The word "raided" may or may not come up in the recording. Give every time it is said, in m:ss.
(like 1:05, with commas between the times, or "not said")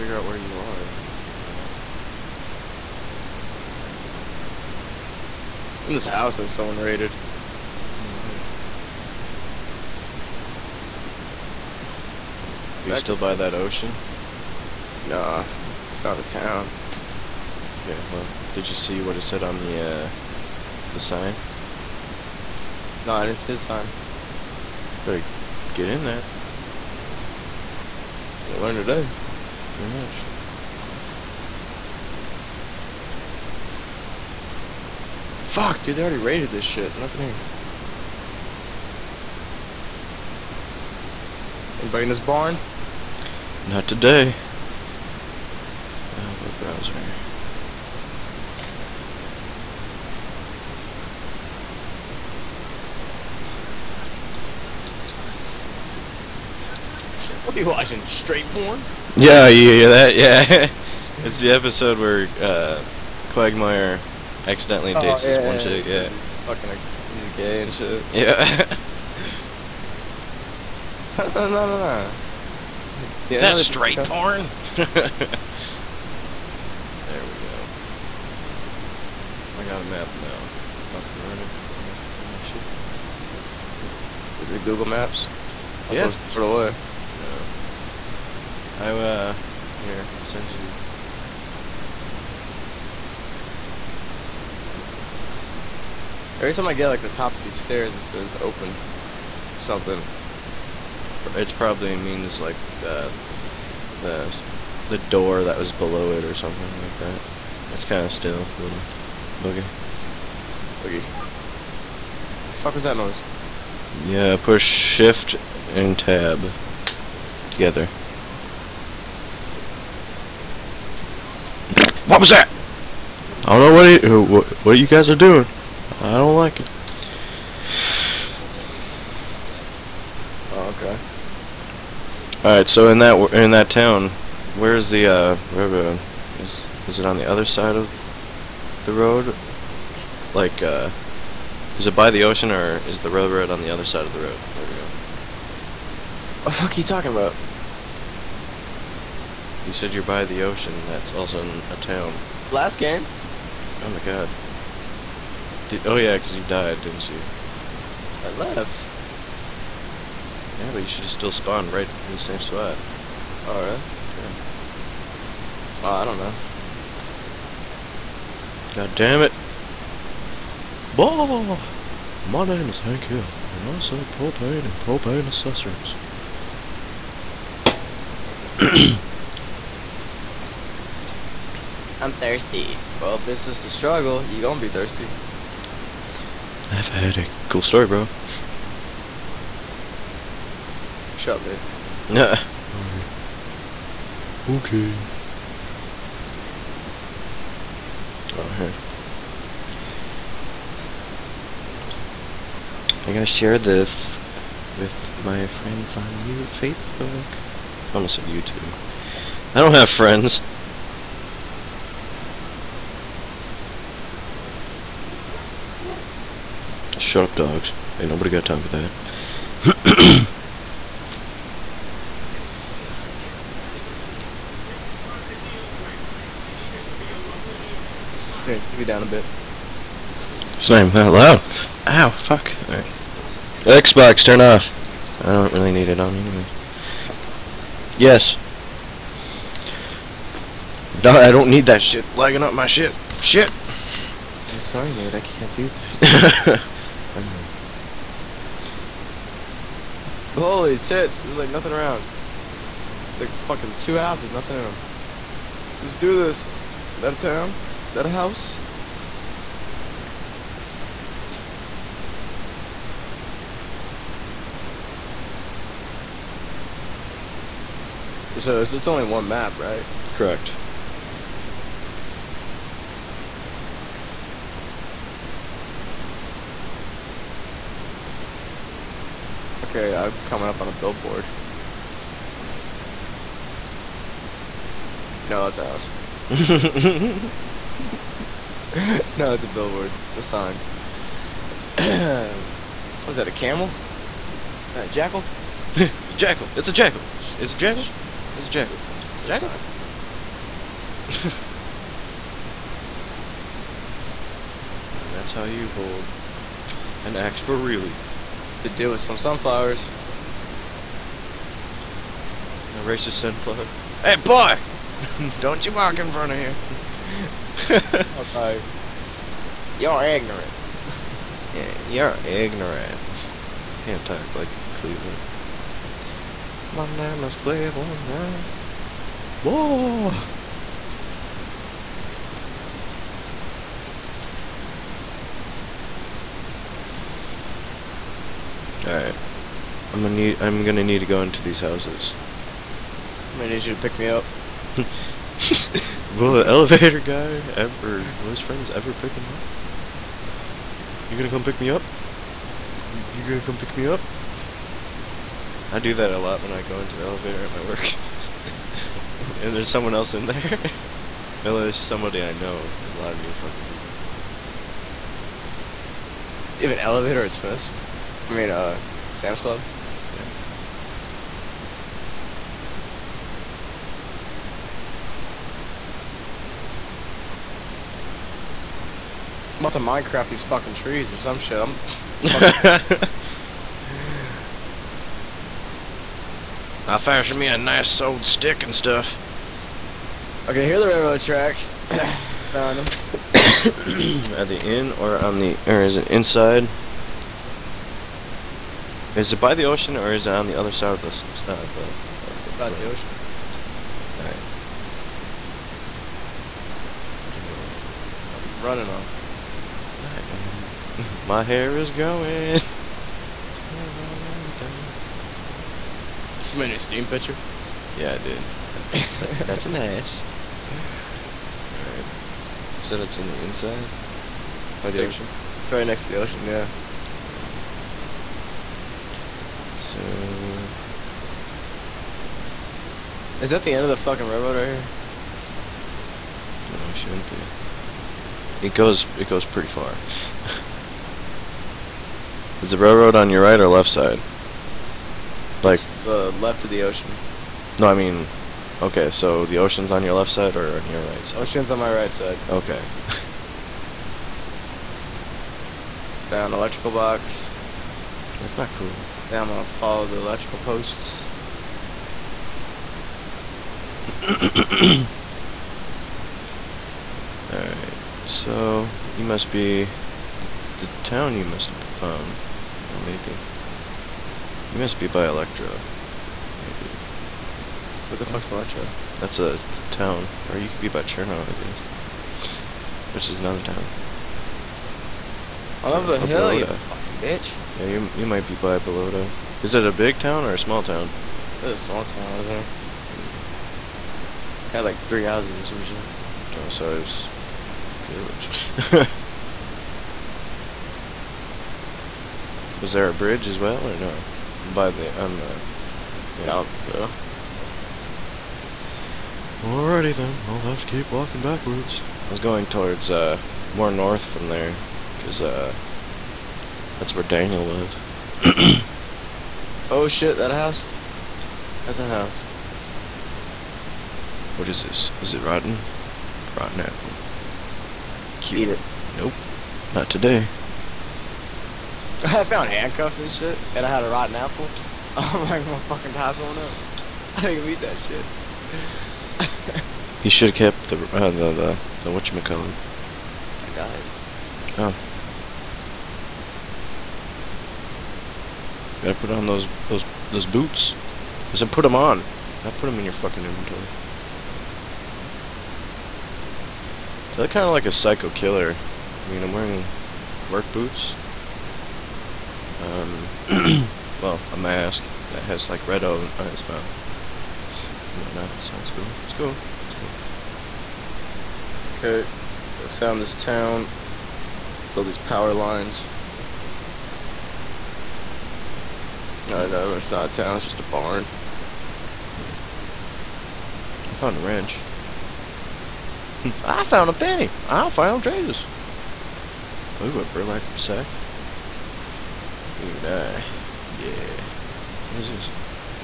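0:06, 0:36.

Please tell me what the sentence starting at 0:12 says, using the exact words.
Are you still by that ocean?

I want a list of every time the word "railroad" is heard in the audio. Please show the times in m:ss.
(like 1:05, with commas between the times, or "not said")
2:15, 2:23, 6:30, 7:14, 7:22.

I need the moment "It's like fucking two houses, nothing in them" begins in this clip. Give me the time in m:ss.
4:13.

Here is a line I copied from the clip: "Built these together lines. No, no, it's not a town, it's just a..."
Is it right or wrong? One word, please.
wrong.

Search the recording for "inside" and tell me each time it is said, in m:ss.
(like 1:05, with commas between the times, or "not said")
6:36, 7:03.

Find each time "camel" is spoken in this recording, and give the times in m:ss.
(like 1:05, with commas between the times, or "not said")
4:53.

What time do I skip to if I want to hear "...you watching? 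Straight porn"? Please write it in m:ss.
0:57.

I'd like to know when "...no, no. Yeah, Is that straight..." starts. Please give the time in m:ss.
1:11.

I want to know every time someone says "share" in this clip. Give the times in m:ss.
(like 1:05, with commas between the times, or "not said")
3:23.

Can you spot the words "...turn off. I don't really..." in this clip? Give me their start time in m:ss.
3:54.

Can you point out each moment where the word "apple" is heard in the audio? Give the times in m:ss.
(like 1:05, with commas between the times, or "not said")
8:46, 8:54.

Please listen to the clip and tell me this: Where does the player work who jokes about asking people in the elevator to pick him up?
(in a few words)
Sam's Club.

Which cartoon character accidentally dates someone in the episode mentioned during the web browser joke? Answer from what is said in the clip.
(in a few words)
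Quagmire.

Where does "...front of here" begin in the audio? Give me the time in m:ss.
5:16.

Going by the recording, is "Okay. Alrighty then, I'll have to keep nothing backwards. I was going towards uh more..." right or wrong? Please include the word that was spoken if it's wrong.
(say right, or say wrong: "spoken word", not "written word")
wrong: "walking", not "nothing".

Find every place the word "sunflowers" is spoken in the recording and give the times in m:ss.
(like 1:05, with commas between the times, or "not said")
5:09, 5:13.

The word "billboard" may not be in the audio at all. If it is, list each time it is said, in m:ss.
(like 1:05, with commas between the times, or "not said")
4:40, 4:49.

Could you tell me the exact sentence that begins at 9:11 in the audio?
I said put them on, not put them in your fucking inventory.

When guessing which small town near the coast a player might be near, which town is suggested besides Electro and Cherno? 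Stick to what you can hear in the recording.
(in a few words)
Balota.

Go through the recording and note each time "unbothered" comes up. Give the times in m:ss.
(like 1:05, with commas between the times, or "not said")
not said.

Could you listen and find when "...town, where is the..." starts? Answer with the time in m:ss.
2:13.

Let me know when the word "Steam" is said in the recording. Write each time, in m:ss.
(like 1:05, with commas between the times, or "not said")
6:56.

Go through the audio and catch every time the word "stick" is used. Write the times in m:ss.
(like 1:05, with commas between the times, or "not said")
6:28.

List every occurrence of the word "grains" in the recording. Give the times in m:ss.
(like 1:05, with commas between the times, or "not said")
not said.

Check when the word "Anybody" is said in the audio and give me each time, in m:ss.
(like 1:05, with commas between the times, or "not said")
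0:41.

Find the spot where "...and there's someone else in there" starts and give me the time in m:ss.
5:59.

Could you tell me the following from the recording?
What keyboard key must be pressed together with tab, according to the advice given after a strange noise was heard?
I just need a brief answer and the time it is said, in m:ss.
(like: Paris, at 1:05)
shift, at 1:54.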